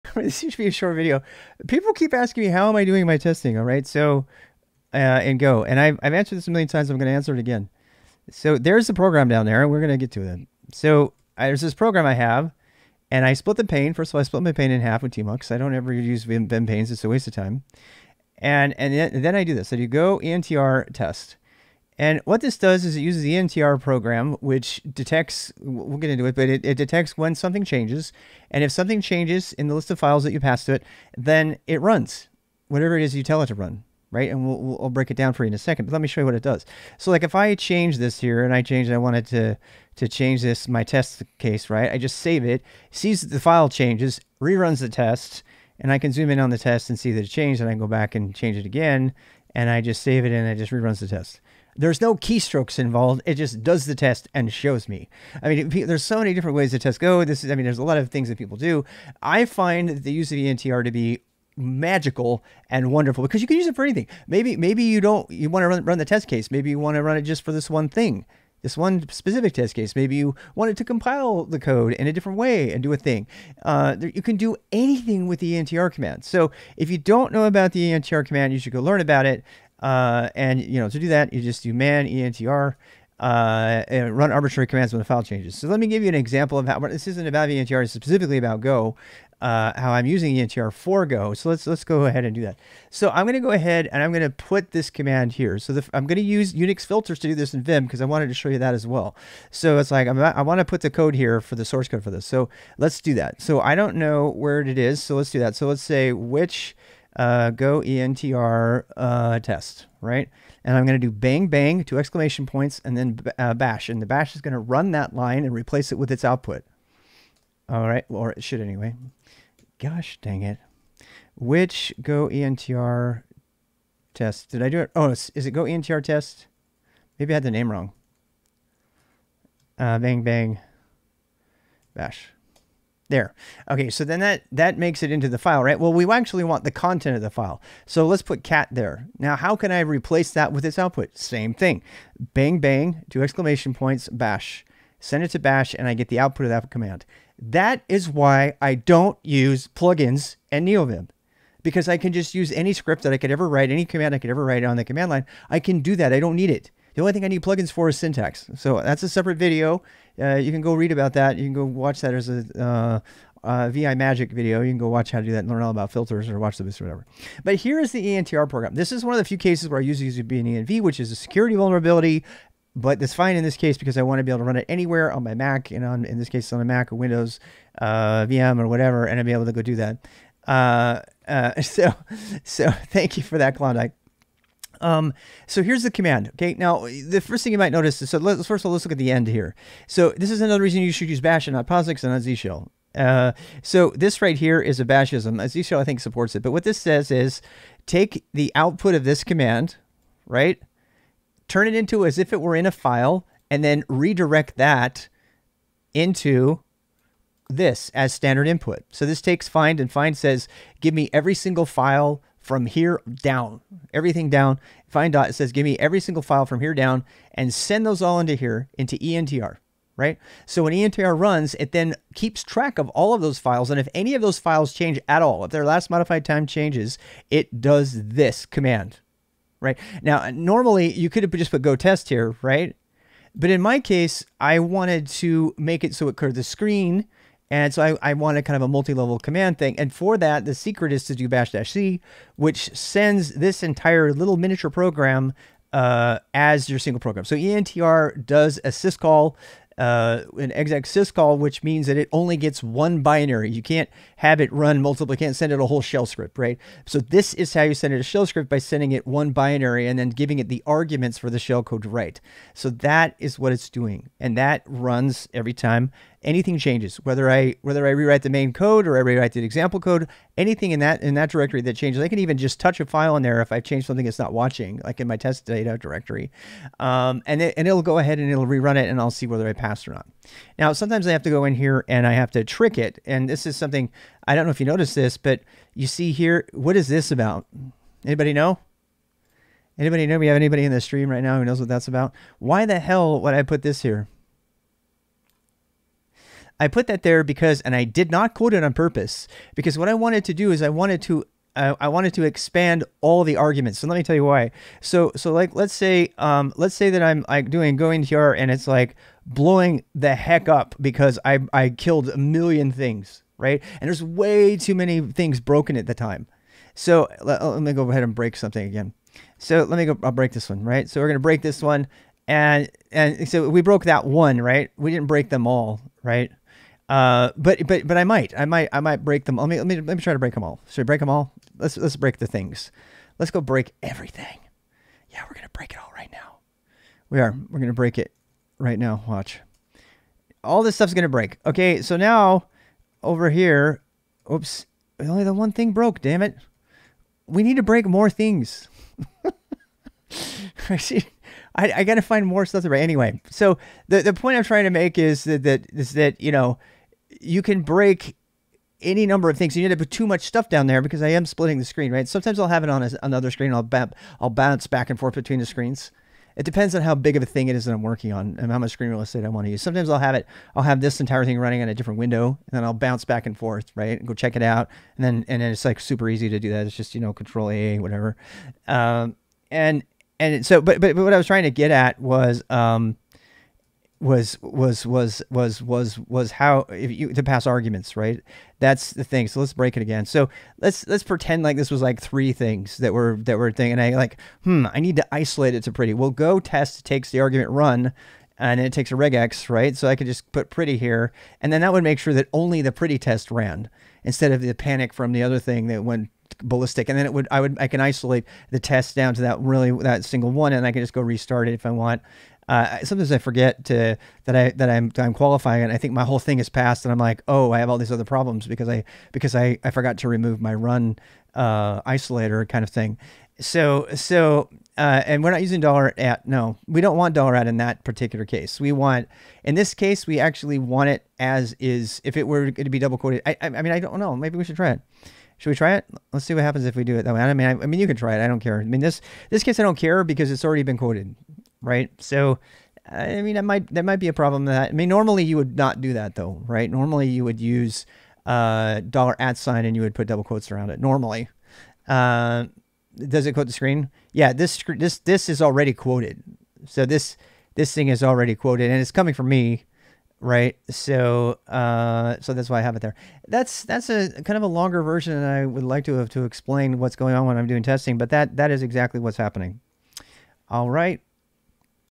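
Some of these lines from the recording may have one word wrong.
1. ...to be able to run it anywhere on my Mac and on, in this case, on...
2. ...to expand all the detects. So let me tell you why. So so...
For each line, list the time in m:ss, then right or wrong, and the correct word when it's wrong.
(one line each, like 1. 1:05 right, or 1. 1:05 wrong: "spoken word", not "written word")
1. 2:54 right
2. 5:02 wrong: "arguments", not "detects".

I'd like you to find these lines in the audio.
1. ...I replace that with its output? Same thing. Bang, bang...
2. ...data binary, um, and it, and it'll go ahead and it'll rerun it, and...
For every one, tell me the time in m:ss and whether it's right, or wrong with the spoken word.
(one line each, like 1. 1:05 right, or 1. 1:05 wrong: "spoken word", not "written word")
1. 2:19 right
2. 4:35 wrong: "directory", not "binary".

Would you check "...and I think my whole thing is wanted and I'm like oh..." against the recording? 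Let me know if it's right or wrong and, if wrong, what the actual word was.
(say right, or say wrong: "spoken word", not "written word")
wrong: "passed", not "wanted".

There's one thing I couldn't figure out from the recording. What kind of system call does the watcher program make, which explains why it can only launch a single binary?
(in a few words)
exec syscall.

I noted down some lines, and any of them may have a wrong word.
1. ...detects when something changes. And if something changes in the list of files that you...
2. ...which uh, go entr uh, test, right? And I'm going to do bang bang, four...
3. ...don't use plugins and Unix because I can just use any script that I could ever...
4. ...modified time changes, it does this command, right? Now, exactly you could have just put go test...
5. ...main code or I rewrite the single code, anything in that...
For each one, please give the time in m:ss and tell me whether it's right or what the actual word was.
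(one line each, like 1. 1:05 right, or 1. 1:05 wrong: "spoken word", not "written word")
1. 0:26 right
2. 1:46 wrong: "two", not "four"
3. 2:28 wrong: "NeoVim", not "Unix"
4. 3:45 wrong: "normally", not "exactly"
5. 4:28 wrong: "example", not "single".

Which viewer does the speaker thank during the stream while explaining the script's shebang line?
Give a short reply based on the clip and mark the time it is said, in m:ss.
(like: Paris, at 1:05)
Klondike, at 3:03.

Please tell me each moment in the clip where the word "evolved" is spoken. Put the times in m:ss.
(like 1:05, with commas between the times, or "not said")
not said.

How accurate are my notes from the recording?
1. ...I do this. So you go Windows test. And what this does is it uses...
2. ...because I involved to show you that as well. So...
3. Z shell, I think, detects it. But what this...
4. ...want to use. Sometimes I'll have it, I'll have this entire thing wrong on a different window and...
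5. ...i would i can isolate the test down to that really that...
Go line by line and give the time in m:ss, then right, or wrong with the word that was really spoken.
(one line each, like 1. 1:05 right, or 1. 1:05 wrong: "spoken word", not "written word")
1. 0:19 wrong: "ENTR", not "Windows"
2. 1:37 wrong: "wanted", not "involved"
3. 3:15 wrong: "supports", not "detects"
4. 6:09 wrong: "running", not "wrong"
5. 6:47 right.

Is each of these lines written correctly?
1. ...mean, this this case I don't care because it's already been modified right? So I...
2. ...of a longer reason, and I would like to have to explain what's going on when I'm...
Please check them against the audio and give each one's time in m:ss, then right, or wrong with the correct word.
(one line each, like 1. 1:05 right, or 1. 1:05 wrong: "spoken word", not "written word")
1. 7:18 wrong: "quoted", not "modified"
2. 7:44 wrong: "version", not "reason".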